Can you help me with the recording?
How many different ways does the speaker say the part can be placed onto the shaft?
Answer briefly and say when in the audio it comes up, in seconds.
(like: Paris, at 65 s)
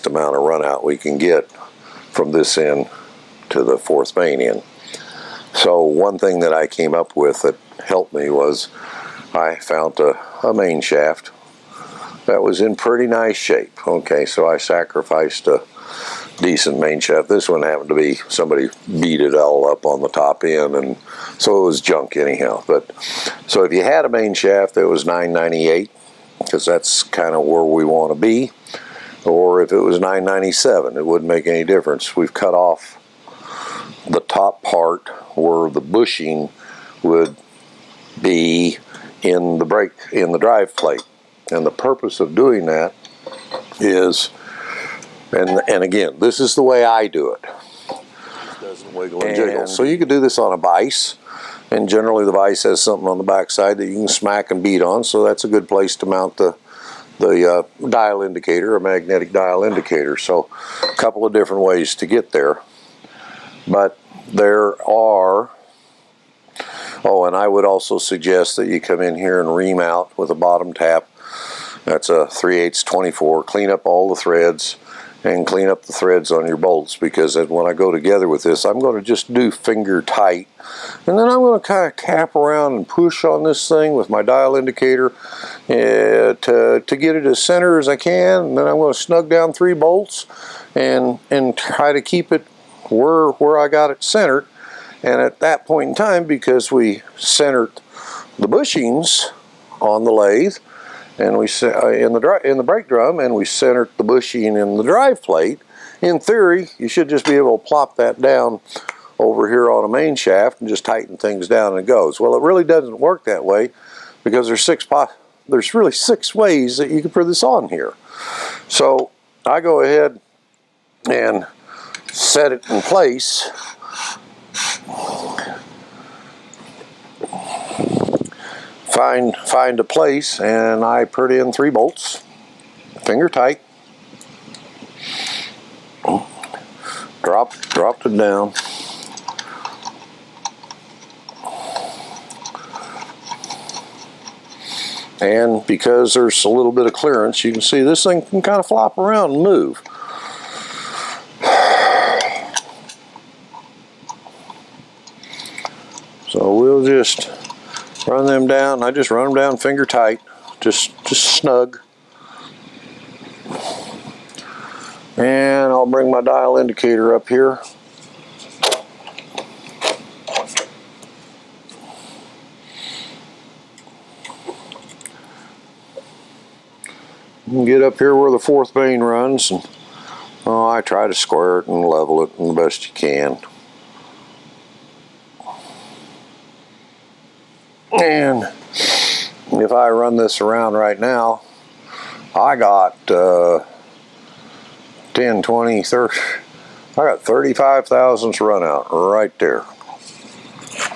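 6, at 115 s.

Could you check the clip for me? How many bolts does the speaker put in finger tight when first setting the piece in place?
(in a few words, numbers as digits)
3.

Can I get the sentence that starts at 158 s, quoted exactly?
I just run them down finger tight.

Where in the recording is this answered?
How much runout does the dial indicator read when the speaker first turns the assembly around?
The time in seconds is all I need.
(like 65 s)
197 s.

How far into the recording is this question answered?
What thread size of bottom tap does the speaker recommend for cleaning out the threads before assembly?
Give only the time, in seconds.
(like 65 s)
72 s.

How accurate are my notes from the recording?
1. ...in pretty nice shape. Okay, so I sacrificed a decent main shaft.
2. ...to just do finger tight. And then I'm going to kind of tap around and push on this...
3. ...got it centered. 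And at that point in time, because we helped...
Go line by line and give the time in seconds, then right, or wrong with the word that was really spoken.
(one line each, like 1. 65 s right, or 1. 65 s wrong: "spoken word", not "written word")
1. 12 s right
2. 78 s right
3. 93 s wrong: "centered", not "helped".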